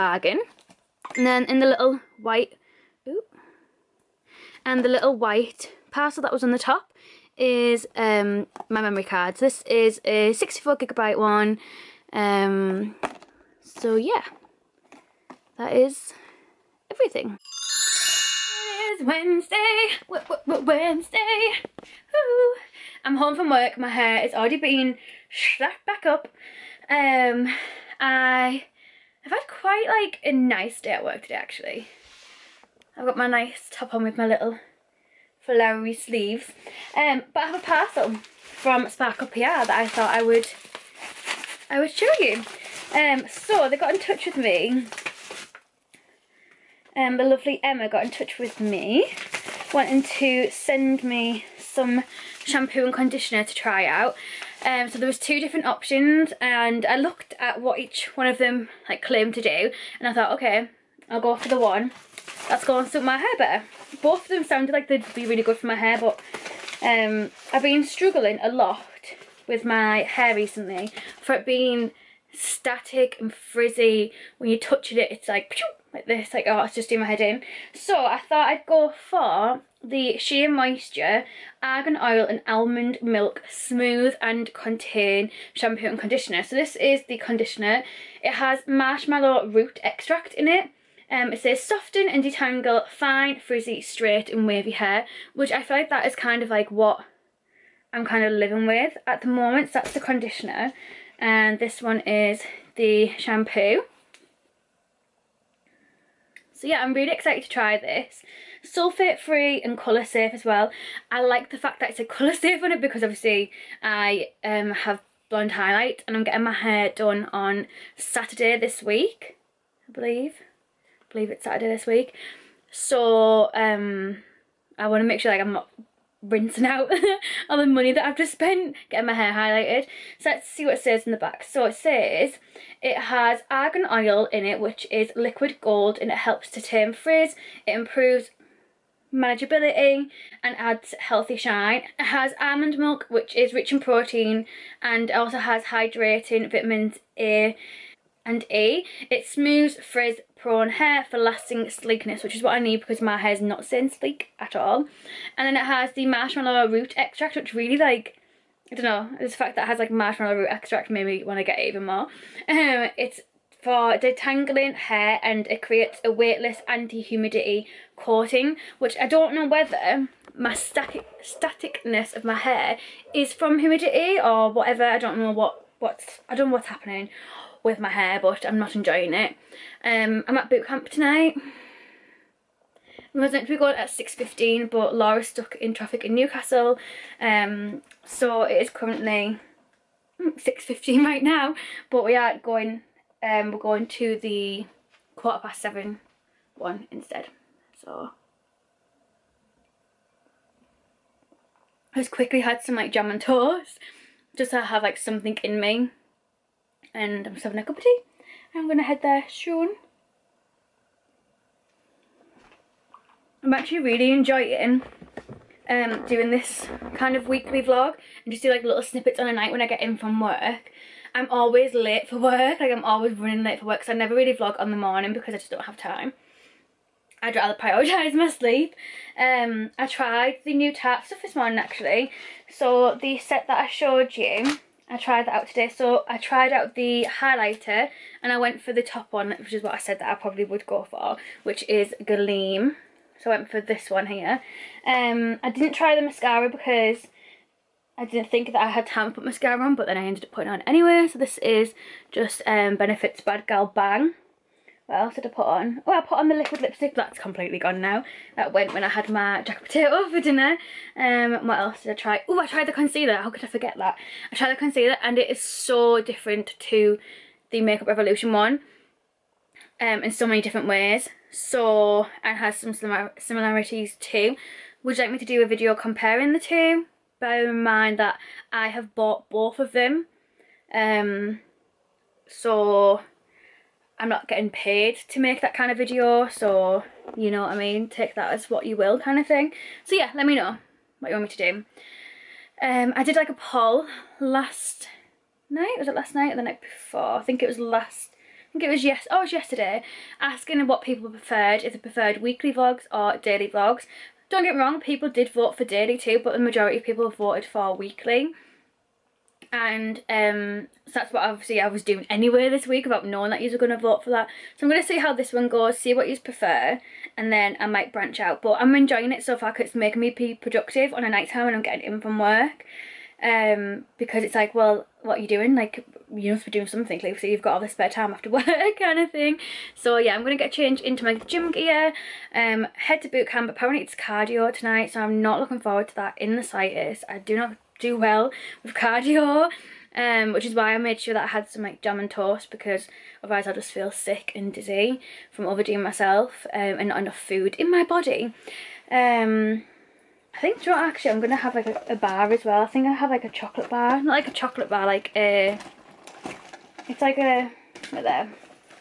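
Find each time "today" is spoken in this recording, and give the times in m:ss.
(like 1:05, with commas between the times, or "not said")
0:31, 3:55.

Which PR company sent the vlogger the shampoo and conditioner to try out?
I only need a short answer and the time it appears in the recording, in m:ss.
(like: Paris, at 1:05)
Sparkle PR, at 0:38.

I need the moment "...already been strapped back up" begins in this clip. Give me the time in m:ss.
0:24.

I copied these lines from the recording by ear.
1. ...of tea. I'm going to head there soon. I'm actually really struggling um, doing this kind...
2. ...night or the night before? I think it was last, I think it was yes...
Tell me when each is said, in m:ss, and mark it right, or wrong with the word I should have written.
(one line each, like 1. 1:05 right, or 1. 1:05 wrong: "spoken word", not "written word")
1. 3:27 wrong: "enjoying", not "struggling"
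2. 4:56 right.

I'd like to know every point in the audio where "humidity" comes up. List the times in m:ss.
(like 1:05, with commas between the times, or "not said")
2:46, 2:53.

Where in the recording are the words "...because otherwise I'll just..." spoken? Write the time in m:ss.
5:42.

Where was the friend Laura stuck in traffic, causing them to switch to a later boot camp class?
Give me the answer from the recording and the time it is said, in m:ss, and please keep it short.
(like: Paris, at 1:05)
Newcastle, at 3:06.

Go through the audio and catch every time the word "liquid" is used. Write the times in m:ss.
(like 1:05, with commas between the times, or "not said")
2:15, 4:16.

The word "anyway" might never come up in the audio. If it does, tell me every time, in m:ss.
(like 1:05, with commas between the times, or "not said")
4:10, 5:12.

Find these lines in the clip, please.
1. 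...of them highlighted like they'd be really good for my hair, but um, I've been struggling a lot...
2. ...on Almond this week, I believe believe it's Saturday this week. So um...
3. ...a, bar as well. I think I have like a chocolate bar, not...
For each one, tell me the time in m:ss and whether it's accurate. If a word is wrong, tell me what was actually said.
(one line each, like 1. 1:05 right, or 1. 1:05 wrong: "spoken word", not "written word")
1. 1:04 wrong: "sounded", not "highlighted"
2. 1:57 wrong: "Saturday", not "Almond"
3. 5:51 right.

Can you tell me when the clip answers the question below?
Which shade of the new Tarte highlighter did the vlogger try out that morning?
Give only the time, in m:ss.
4:02.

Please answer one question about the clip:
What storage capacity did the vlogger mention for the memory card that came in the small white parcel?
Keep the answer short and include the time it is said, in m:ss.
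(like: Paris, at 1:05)
64 gigabyte, at 0:10.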